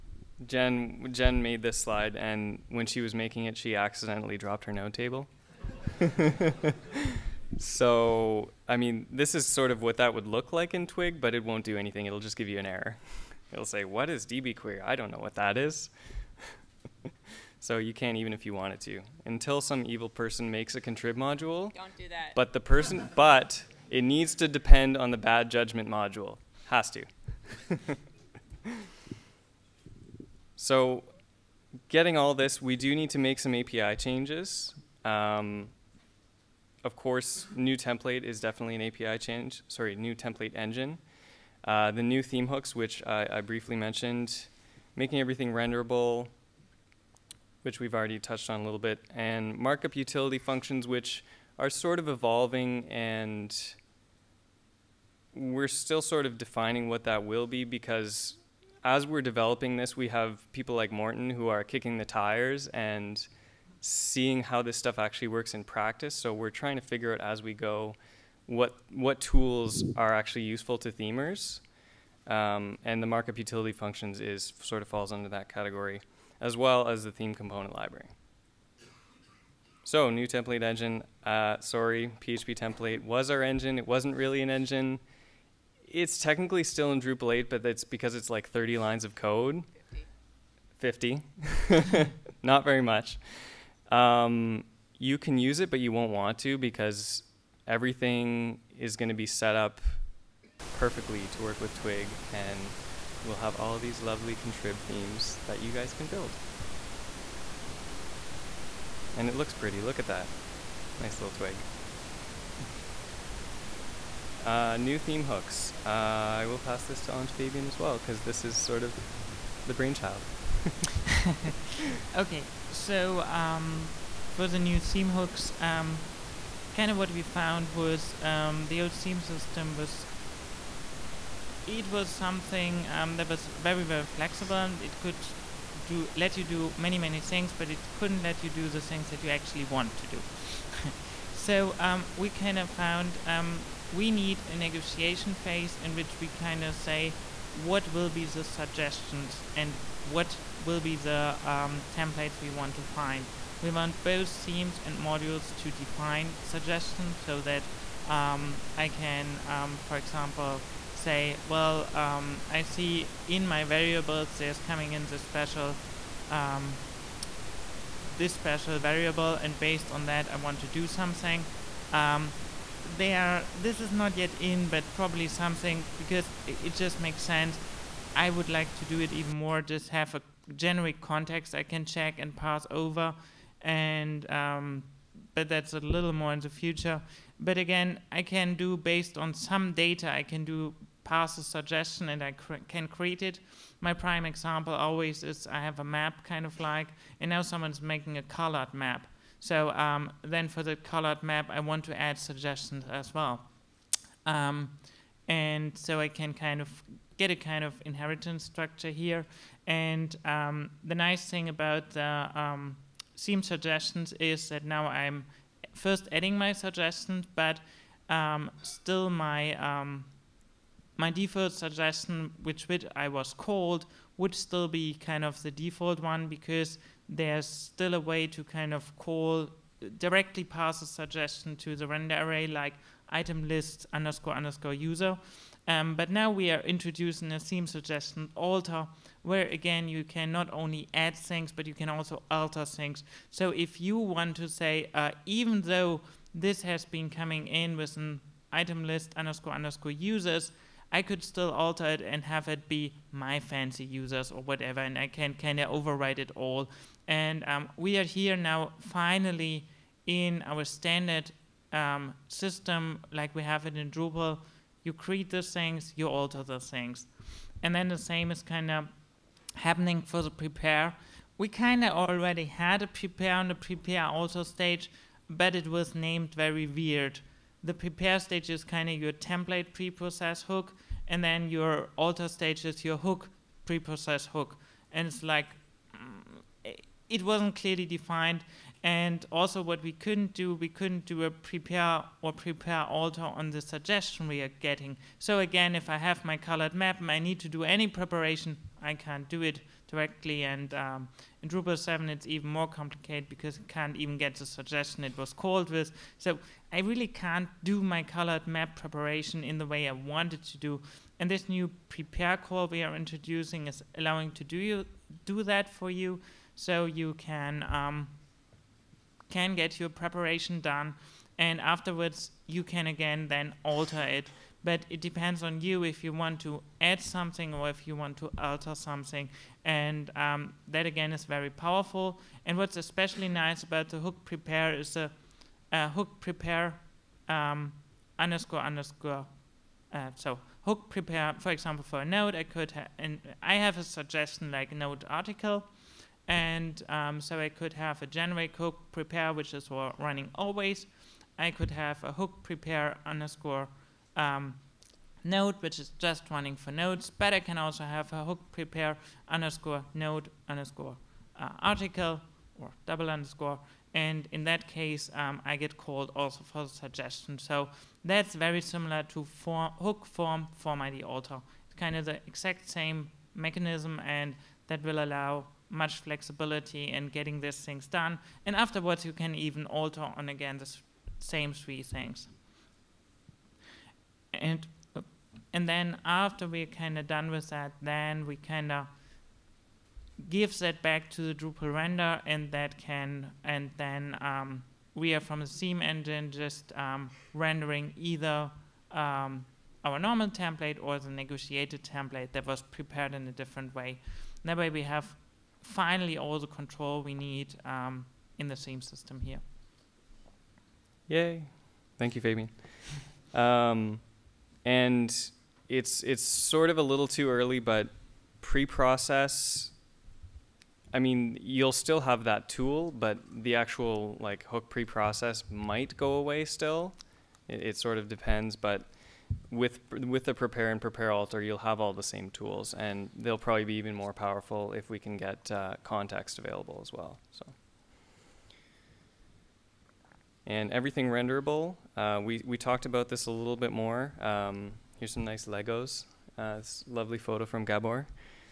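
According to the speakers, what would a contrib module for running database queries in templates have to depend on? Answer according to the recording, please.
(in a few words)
bad judgment module.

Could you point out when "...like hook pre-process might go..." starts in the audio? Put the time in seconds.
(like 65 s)
424 s.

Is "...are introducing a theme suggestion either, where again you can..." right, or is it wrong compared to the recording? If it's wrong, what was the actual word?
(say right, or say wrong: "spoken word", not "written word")
wrong: "alter", not "either".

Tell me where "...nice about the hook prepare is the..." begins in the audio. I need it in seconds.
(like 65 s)
333 s.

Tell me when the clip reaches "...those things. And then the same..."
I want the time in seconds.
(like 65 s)
266 s.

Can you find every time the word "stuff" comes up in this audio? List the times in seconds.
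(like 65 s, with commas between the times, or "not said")
64 s.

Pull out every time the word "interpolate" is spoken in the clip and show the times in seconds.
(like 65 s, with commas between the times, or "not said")
not said.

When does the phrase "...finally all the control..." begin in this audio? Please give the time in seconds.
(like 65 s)
405 s.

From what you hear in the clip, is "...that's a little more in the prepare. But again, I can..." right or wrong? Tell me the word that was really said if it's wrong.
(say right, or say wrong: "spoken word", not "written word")
wrong: "future", not "prepare".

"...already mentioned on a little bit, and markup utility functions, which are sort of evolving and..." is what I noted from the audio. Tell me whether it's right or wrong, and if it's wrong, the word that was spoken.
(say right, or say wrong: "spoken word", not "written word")
wrong: "touched", not "mentioned".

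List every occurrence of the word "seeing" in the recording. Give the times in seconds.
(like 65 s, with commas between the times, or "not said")
63 s.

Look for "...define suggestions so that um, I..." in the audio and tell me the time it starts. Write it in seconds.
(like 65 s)
155 s.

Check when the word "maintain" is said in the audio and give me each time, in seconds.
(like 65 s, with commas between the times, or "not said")
not said.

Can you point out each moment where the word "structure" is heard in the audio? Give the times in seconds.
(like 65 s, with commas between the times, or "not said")
208 s.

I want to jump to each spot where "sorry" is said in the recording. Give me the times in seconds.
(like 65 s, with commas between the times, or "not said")
39 s, 81 s.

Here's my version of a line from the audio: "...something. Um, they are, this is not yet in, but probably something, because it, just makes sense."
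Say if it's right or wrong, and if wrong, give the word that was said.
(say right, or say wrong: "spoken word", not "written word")
right.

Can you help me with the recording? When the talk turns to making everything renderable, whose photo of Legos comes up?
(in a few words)
Gabor.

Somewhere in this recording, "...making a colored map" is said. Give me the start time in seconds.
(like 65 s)
197 s.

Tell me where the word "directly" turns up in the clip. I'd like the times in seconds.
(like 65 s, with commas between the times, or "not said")
229 s, 299 s.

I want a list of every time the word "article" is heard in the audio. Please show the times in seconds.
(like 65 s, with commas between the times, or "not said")
345 s, 361 s.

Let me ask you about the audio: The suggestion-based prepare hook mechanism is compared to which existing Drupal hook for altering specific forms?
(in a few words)
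hook form form ID alter.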